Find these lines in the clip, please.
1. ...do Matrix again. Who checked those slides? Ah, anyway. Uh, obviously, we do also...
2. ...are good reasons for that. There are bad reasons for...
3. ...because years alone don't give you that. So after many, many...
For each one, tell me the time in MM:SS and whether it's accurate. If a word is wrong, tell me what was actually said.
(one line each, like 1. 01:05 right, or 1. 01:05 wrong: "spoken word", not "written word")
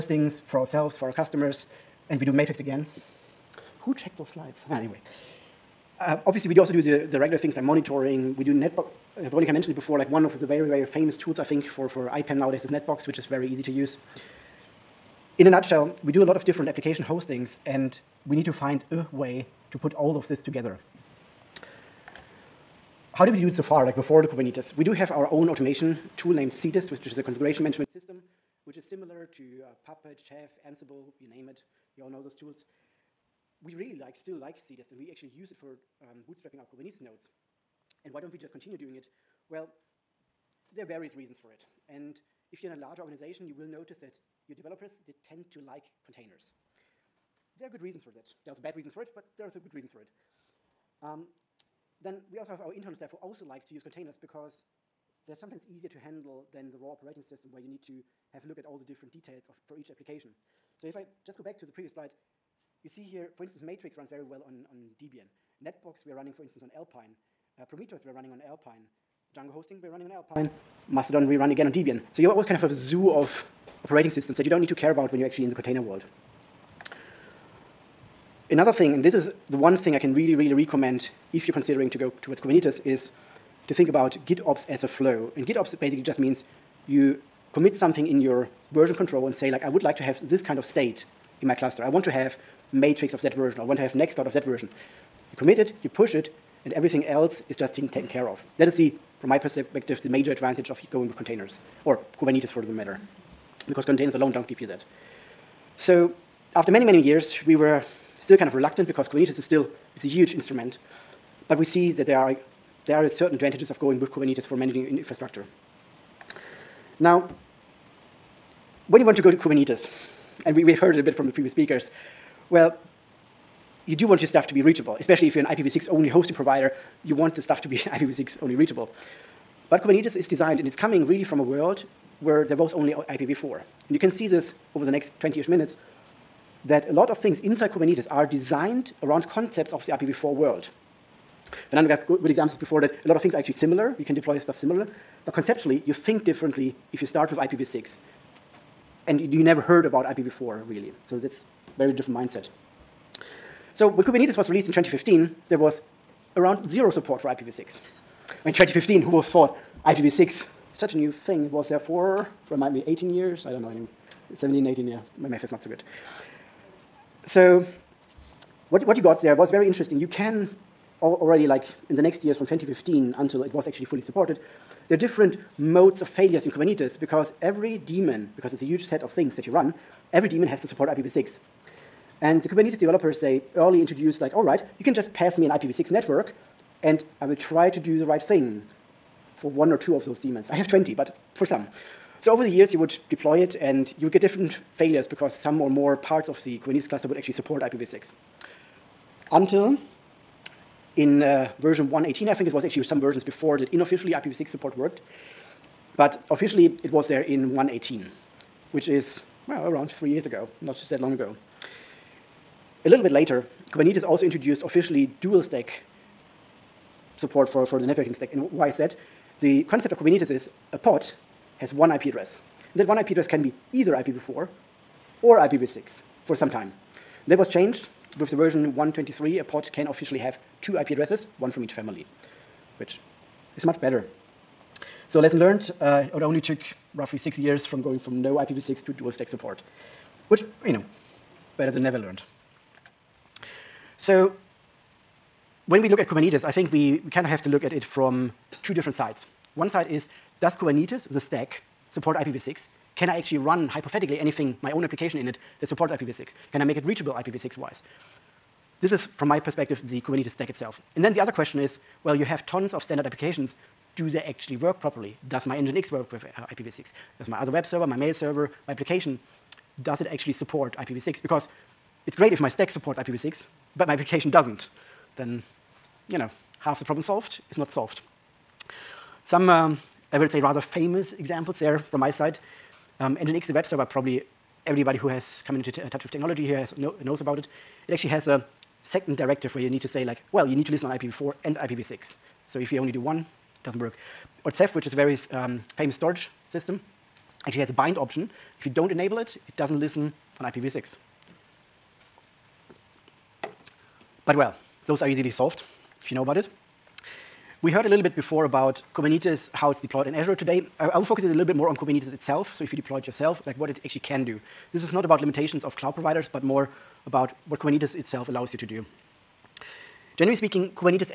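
1. 00:02 right
2. 00:47 right
3. 01:43 wrong: "containers", not "years".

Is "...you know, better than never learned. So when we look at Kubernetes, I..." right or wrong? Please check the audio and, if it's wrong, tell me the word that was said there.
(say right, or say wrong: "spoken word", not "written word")
right.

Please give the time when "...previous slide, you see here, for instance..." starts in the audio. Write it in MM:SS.
01:01.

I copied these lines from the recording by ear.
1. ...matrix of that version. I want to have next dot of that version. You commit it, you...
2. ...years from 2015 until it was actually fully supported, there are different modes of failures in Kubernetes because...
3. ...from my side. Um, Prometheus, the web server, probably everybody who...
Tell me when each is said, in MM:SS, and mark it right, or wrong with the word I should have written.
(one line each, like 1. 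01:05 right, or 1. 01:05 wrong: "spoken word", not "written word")
1. 01:32 right
2. 02:52 right
3. 04:41 wrong: "Nginx", not "Prometheus".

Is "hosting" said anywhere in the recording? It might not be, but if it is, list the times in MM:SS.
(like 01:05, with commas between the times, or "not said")
00:17, 01:09, 02:06.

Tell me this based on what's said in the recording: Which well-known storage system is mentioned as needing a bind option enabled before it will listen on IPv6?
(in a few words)
Ceph.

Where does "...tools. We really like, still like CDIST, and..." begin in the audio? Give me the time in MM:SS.
00:32.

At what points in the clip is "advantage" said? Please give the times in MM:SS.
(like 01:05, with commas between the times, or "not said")
01:40, 01:53.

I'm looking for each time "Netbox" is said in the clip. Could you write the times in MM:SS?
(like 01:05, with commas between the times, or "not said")
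00:12, 01:05.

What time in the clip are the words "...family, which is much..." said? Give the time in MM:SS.
03:51.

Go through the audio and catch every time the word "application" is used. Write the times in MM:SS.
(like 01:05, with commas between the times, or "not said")
00:16, 00:59, 04:14, 04:23, 04:28, 04:33.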